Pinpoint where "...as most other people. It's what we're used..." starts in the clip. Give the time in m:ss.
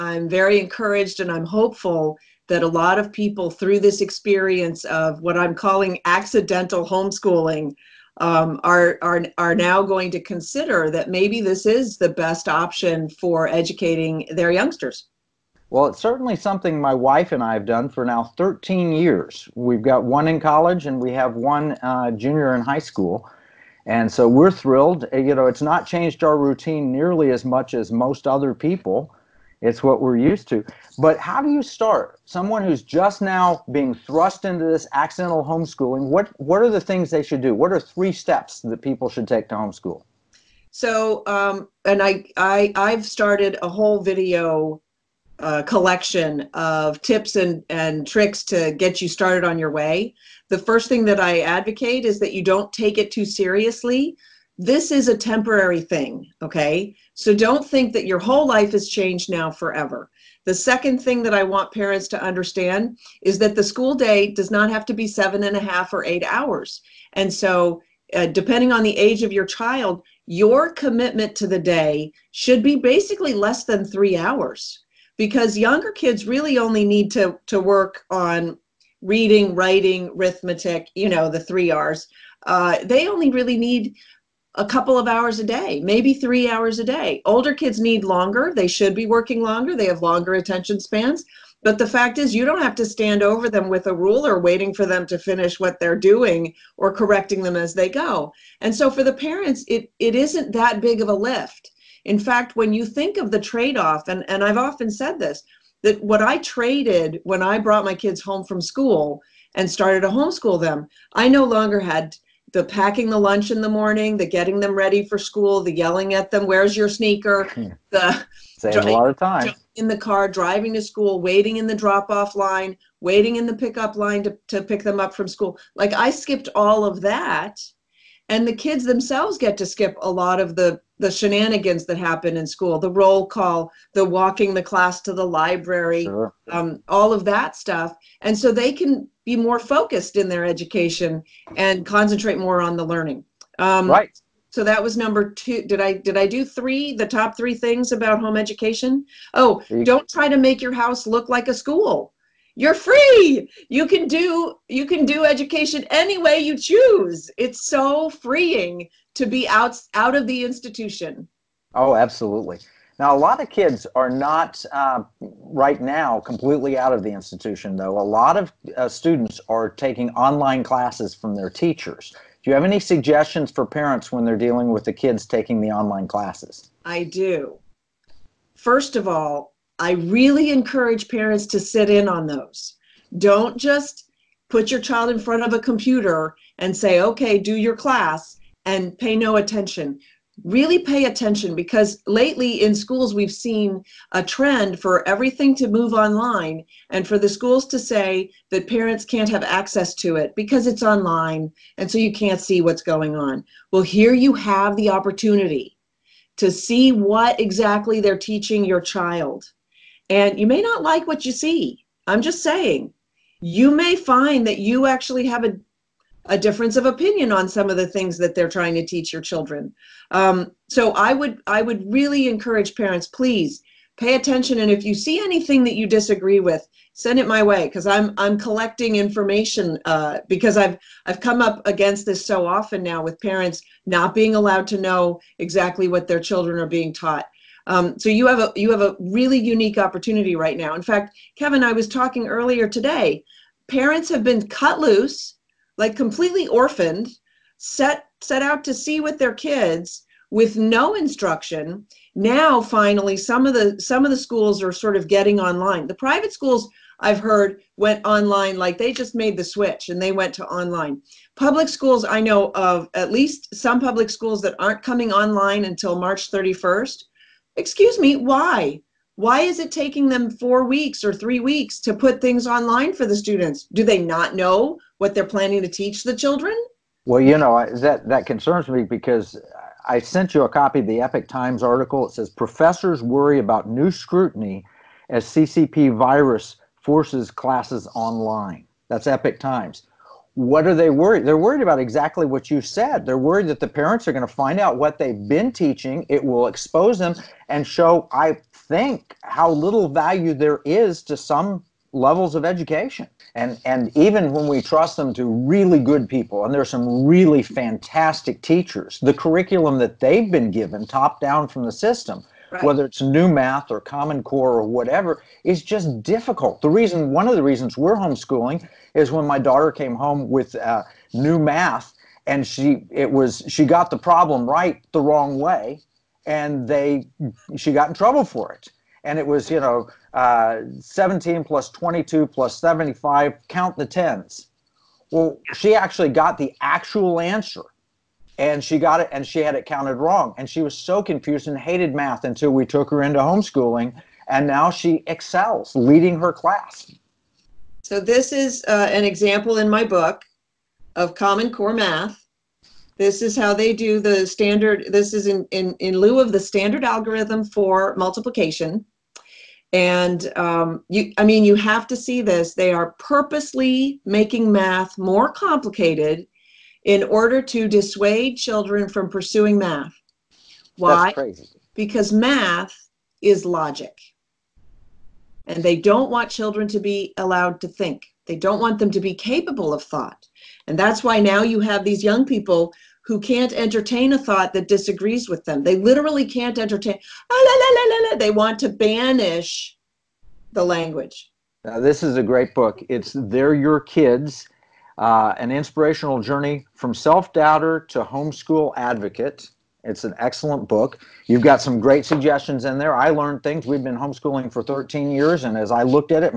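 0:27.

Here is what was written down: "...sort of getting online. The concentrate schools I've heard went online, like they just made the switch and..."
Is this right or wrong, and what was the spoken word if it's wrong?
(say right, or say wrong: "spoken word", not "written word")
wrong: "private", not "concentrate".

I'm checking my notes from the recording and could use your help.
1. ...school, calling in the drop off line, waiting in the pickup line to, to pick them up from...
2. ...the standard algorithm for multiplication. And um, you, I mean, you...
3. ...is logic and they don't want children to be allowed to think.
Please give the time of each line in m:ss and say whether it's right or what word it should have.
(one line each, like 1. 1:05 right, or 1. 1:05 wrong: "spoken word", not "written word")
1. 2:00 wrong: "waiting", not "calling"
2. 5:56 right
3. 6:13 right.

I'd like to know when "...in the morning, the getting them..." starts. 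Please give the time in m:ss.
1:53.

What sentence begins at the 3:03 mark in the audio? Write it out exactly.
Don't just put your child in front of a computer and say, okay, do your class and pay no attention.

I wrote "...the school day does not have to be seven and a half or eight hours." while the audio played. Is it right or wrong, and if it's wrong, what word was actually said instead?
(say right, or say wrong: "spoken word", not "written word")
right.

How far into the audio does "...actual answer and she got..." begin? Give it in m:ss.
5:36.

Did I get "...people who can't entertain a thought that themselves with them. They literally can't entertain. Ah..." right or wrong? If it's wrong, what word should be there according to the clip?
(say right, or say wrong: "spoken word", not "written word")
wrong: "disagrees", not "themselves".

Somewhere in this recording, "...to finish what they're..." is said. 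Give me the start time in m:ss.
1:35.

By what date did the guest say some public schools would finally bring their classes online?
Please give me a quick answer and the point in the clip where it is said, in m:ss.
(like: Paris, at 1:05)
March 31st, at 4:25.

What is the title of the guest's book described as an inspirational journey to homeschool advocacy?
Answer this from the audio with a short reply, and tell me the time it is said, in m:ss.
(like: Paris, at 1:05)
They're Your Kids, at 6:33.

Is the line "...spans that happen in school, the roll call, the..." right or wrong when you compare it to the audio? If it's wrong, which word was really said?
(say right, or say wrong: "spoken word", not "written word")
wrong: "shenanigans", not "spans".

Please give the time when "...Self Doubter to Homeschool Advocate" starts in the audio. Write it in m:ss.
6:36.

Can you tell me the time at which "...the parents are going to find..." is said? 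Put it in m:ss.
4:53.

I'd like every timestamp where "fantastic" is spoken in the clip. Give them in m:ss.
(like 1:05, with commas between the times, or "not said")
5:07.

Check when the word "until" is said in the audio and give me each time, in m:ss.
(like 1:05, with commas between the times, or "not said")
4:25, 5:42.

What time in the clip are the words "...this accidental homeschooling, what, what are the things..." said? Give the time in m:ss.
0:34.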